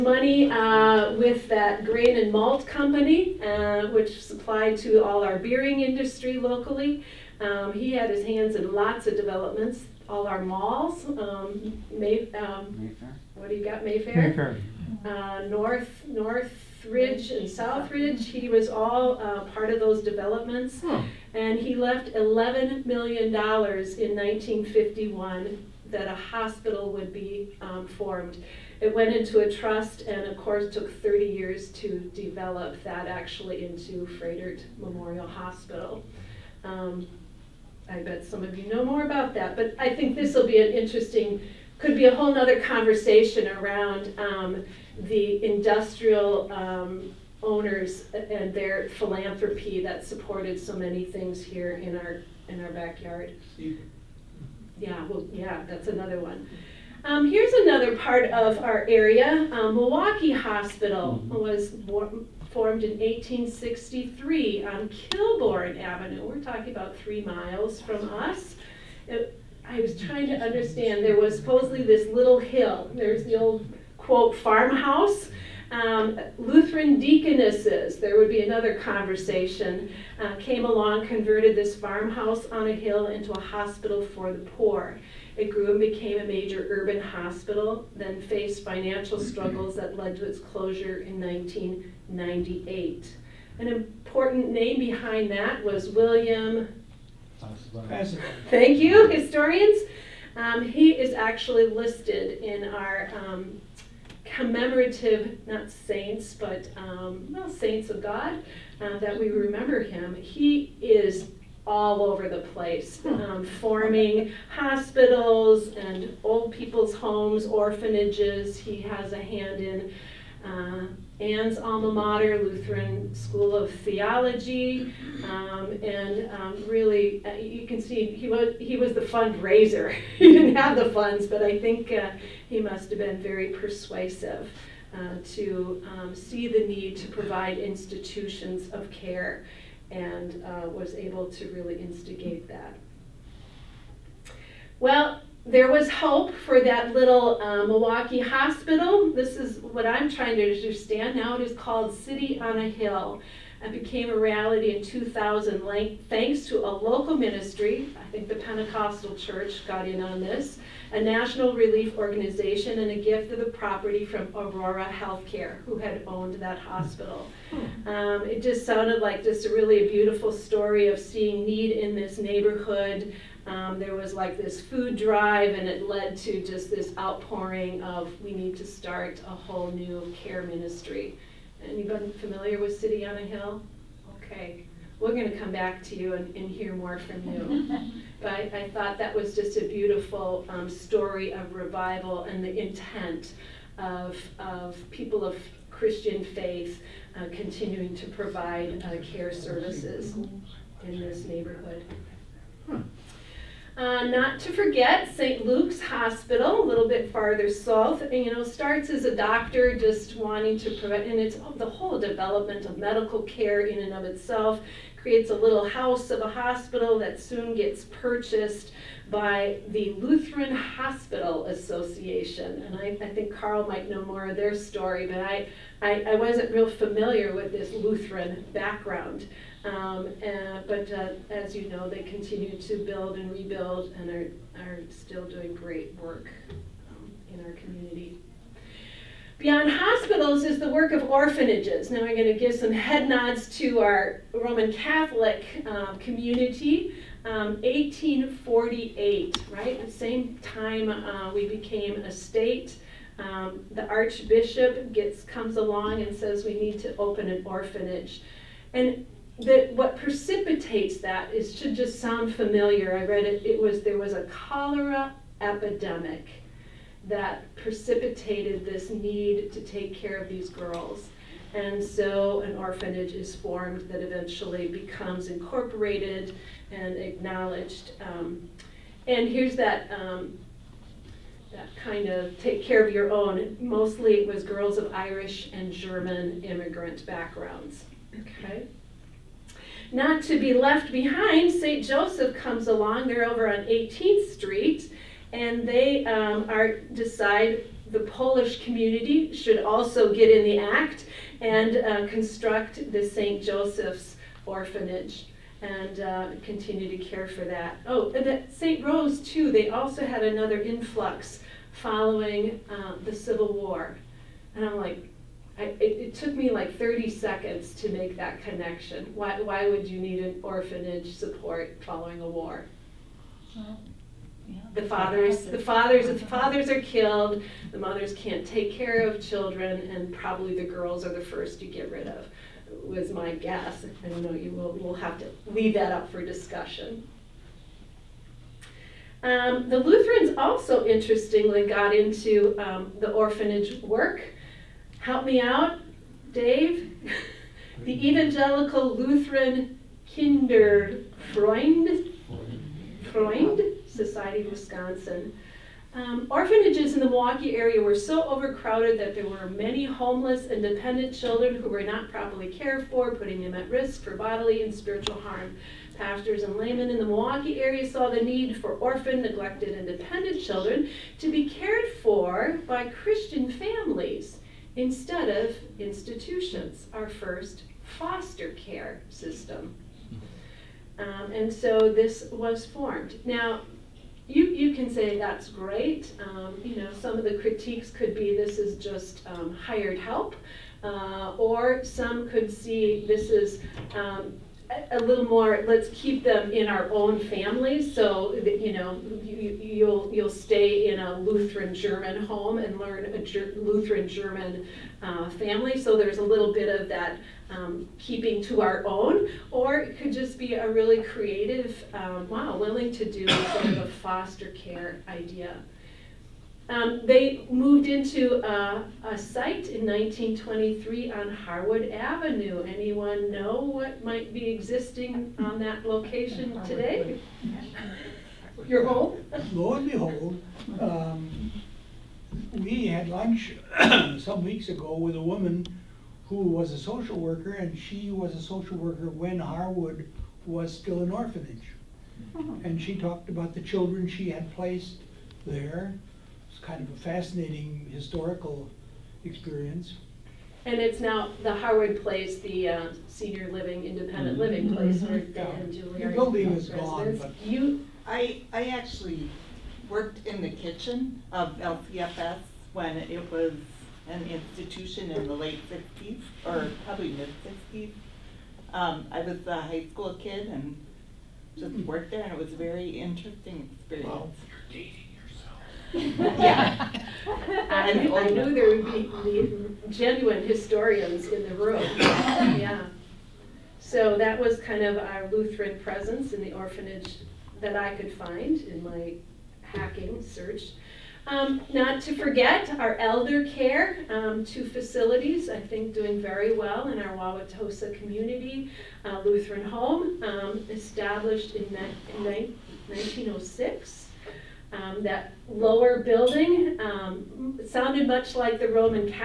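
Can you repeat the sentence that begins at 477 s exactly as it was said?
I, knew, I knew there would be genuine historians in the room.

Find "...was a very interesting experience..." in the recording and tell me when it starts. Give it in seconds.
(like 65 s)
472 s.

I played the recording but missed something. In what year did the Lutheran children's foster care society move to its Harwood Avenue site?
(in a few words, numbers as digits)
1923.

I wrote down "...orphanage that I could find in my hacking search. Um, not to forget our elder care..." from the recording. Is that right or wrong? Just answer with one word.
right.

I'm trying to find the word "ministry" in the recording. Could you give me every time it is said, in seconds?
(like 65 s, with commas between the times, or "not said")
157 s, 180 s.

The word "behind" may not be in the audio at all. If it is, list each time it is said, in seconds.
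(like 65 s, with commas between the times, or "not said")
94 s, 290 s.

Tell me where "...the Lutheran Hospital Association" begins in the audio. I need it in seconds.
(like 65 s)
219 s.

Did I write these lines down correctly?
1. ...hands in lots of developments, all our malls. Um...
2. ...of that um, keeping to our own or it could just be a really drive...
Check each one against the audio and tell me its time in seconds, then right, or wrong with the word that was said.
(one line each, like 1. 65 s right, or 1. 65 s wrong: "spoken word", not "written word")
1. 8 s right
2. 406 s wrong: "creative", not "drive".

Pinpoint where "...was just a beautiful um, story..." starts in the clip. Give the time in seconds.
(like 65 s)
189 s.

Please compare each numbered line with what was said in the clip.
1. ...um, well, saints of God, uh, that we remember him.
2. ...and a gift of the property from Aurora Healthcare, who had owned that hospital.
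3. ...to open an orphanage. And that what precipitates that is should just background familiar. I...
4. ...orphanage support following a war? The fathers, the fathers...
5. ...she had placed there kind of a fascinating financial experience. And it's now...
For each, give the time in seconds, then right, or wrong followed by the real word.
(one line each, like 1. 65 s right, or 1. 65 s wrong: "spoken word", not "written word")
1. 106 s right
2. 162 s right
3. 256 s wrong: "sound", not "background"
4. 320 s right
5. 444 s wrong: "historical", not "financial".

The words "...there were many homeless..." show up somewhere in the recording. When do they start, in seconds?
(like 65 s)
359 s.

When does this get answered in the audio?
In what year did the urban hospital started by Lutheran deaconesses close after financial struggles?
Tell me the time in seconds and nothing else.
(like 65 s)
91 s.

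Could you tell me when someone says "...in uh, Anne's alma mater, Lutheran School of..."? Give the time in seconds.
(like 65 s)
119 s.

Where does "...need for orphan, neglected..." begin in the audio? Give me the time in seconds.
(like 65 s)
368 s.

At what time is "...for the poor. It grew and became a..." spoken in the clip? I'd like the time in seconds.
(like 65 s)
84 s.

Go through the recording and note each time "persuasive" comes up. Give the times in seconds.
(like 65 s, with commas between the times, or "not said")
133 s.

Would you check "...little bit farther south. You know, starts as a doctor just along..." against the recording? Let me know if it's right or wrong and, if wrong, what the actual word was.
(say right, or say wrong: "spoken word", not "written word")
wrong: "wanting", not "along".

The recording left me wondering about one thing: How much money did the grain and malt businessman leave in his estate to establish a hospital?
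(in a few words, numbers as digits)
$11 million.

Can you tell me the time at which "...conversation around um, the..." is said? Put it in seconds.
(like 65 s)
42 s.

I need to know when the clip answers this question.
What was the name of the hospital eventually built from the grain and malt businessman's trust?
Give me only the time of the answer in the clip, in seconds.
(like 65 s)
34 s.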